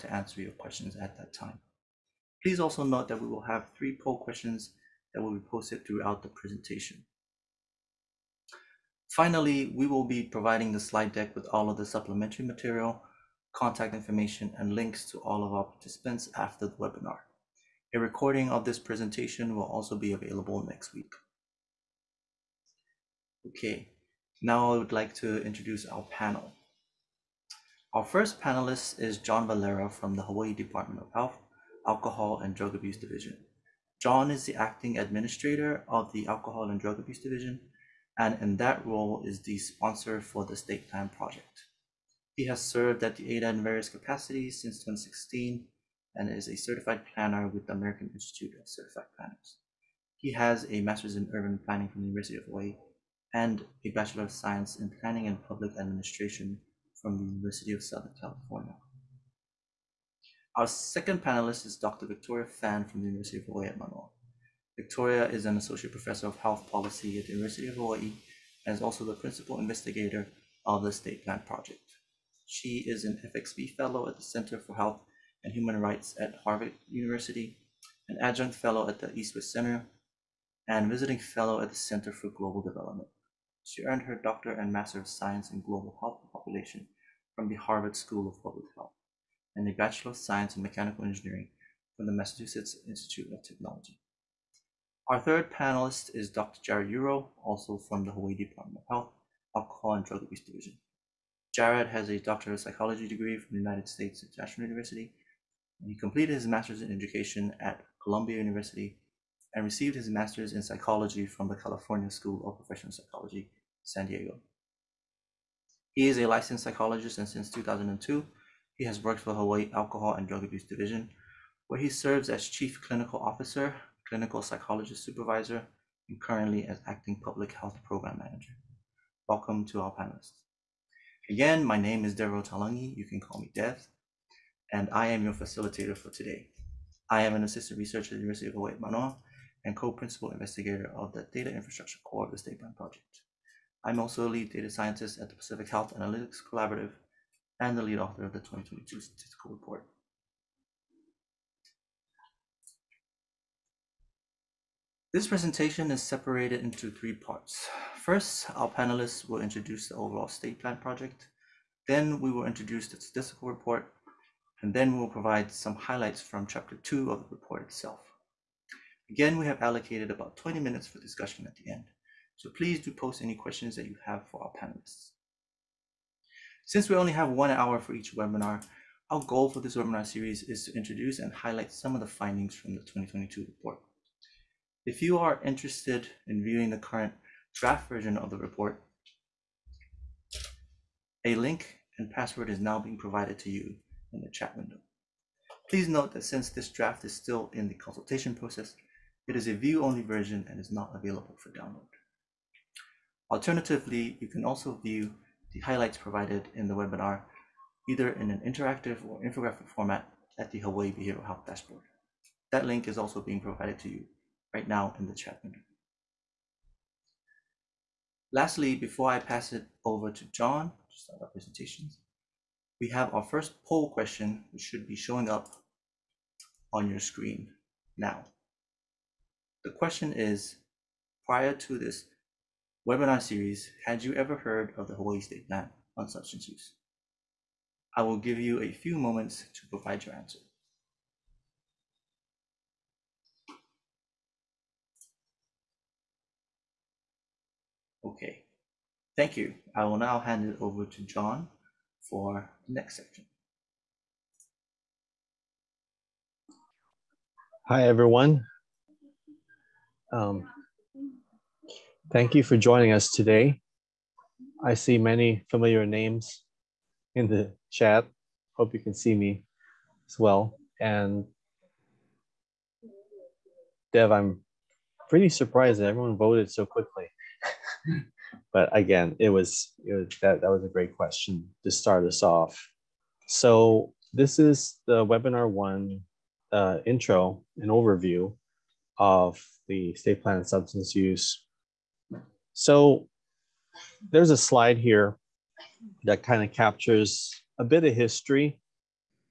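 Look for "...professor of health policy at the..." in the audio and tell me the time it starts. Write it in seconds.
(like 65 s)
65 s.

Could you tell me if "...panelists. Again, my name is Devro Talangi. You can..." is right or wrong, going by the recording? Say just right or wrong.
right.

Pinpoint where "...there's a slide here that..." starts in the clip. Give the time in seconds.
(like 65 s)
294 s.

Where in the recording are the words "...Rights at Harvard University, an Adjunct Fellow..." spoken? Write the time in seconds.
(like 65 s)
75 s.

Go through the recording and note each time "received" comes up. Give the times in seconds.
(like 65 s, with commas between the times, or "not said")
109 s.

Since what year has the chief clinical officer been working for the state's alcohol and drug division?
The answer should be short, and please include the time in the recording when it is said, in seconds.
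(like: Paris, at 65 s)
2002, at 117 s.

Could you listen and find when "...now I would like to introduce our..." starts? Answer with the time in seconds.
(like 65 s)
24 s.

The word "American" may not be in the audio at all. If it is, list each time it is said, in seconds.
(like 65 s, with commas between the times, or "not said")
47 s.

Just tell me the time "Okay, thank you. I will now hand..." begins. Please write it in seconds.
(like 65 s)
248 s.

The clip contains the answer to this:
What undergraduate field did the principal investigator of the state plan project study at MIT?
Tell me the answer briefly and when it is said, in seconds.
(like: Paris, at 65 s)
Mechanical Engineering, at 90 s.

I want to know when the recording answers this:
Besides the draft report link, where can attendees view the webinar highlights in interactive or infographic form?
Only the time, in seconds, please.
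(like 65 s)
210 s.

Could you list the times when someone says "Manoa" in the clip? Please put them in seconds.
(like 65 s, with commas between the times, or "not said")
63 s, 138 s.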